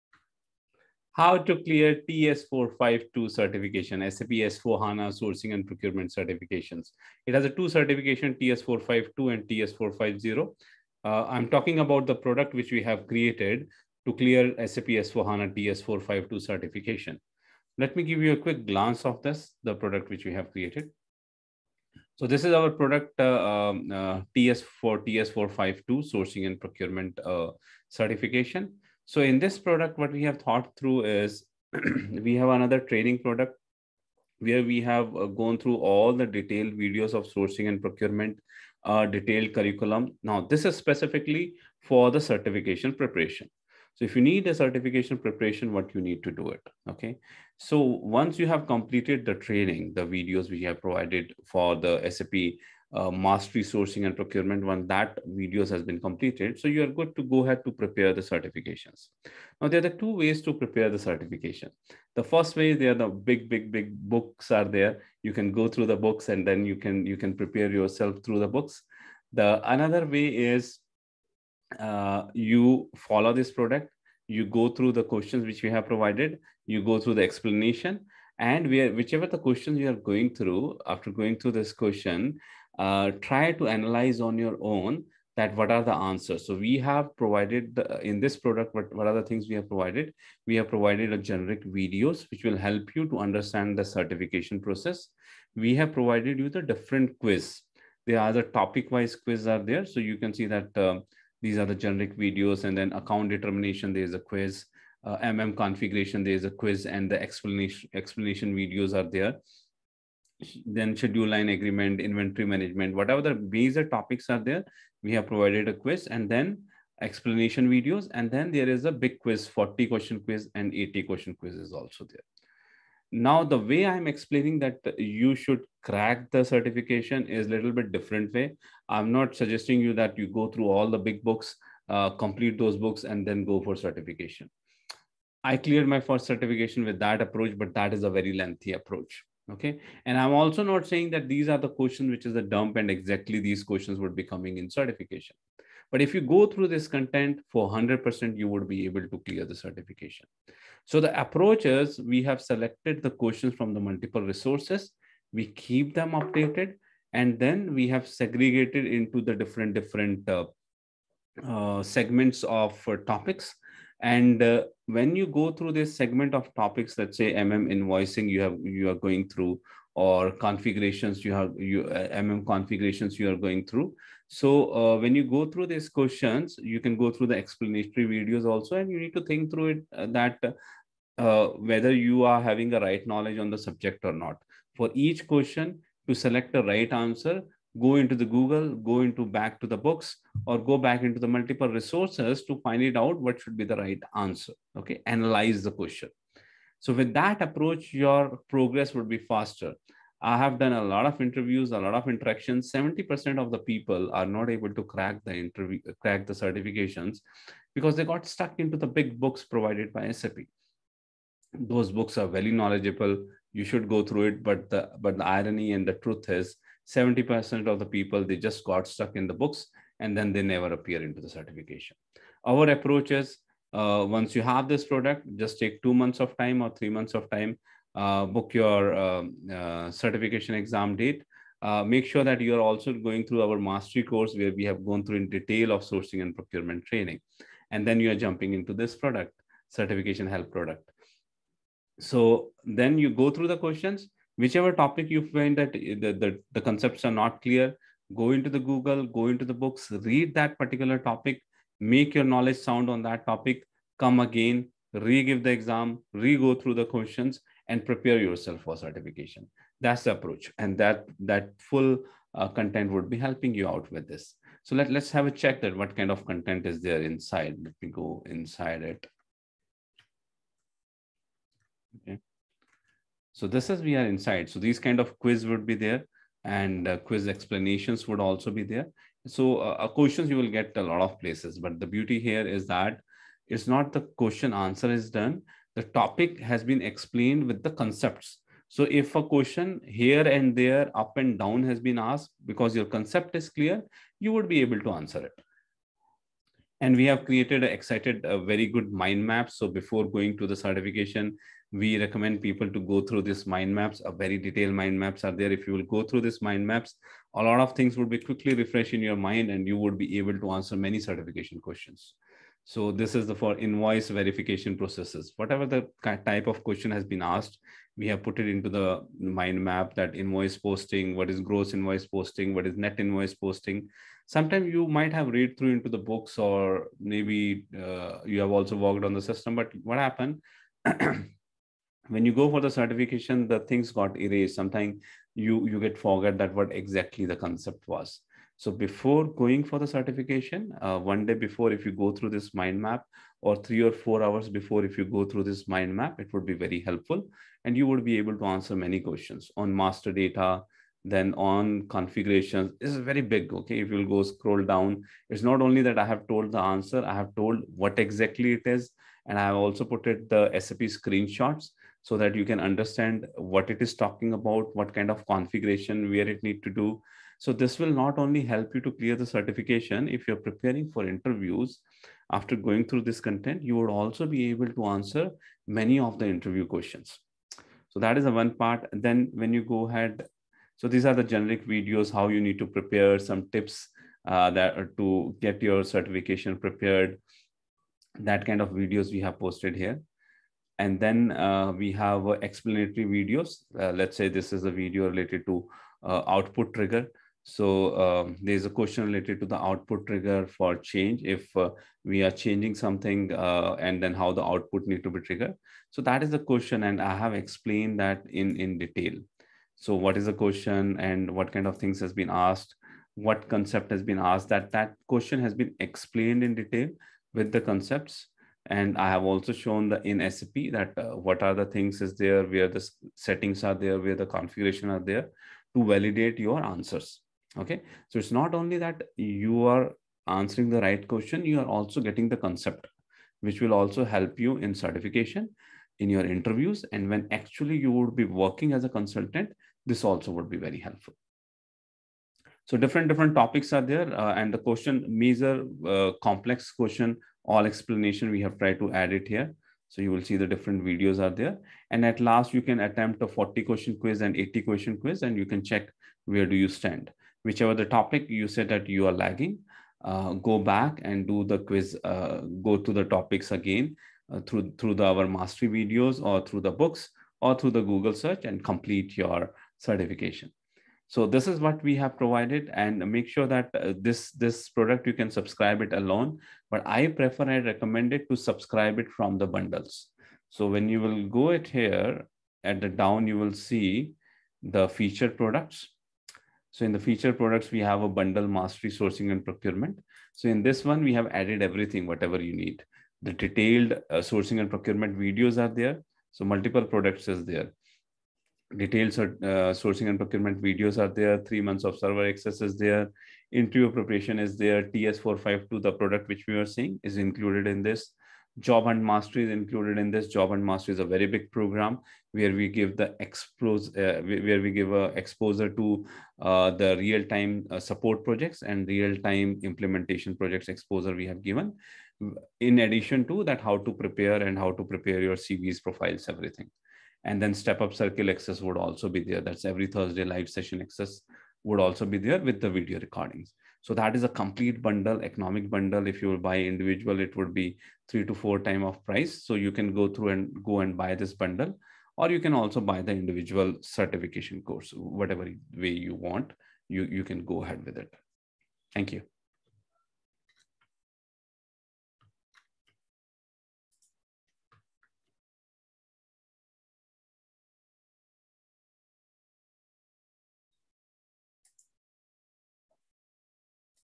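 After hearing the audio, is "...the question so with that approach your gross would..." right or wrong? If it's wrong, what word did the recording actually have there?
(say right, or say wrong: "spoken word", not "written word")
wrong: "progress", not "gross".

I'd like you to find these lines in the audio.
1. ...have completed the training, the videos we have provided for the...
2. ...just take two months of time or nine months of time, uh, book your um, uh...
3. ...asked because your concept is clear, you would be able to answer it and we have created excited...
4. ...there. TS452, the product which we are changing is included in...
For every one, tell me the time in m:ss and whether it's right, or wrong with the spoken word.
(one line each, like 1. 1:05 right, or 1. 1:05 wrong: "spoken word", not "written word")
1. 0:48 right
2. 3:45 wrong: "three", not "nine"
3. 4:51 right
4. 8:24 wrong: "seeing", not "changing".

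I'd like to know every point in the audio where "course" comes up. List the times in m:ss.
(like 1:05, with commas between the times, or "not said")
3:54, 9:04.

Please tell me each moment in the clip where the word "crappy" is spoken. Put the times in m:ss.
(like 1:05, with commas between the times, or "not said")
not said.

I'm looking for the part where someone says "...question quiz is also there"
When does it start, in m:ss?
2:01.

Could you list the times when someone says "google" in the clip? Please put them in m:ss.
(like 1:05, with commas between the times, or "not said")
3:08, 4:08, 7:47.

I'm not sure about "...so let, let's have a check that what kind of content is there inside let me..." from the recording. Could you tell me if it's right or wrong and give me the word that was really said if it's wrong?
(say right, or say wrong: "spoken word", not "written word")
right.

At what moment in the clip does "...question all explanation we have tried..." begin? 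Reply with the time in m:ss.
7:26.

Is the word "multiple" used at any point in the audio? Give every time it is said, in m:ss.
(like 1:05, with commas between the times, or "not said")
2:33, 3:11, 8:16.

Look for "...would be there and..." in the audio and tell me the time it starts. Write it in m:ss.
4:35.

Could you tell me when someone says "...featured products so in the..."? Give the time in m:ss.
8:04.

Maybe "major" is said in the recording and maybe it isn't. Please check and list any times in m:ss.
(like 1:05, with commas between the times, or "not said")
1:53, 7:25.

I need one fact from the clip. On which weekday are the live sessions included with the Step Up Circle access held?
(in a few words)
Thursday.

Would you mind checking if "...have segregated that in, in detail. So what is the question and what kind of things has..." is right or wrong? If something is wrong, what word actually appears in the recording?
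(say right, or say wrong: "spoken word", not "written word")
wrong: "explained", not "segregated".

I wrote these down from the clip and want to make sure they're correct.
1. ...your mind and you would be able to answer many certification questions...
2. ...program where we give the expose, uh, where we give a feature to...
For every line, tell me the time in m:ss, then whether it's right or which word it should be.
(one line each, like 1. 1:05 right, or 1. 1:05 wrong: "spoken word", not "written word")
1. 5:09 right
2. 8:31 wrong: "exposure", not "feature".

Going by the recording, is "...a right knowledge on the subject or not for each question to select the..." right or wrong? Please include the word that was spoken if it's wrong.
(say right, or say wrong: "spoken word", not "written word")
right.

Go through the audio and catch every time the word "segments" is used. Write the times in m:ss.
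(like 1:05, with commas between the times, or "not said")
2:41, 2:45.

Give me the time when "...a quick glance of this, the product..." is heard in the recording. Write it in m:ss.
0:18.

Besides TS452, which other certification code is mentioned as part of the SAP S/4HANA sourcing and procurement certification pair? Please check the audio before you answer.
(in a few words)
TS450.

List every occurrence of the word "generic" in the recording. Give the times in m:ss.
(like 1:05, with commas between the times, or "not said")
1:31, 1:41, 6:21.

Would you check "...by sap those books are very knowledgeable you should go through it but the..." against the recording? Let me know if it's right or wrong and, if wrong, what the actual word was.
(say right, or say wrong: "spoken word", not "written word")
right.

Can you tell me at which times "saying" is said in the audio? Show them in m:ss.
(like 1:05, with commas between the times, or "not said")
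2:20.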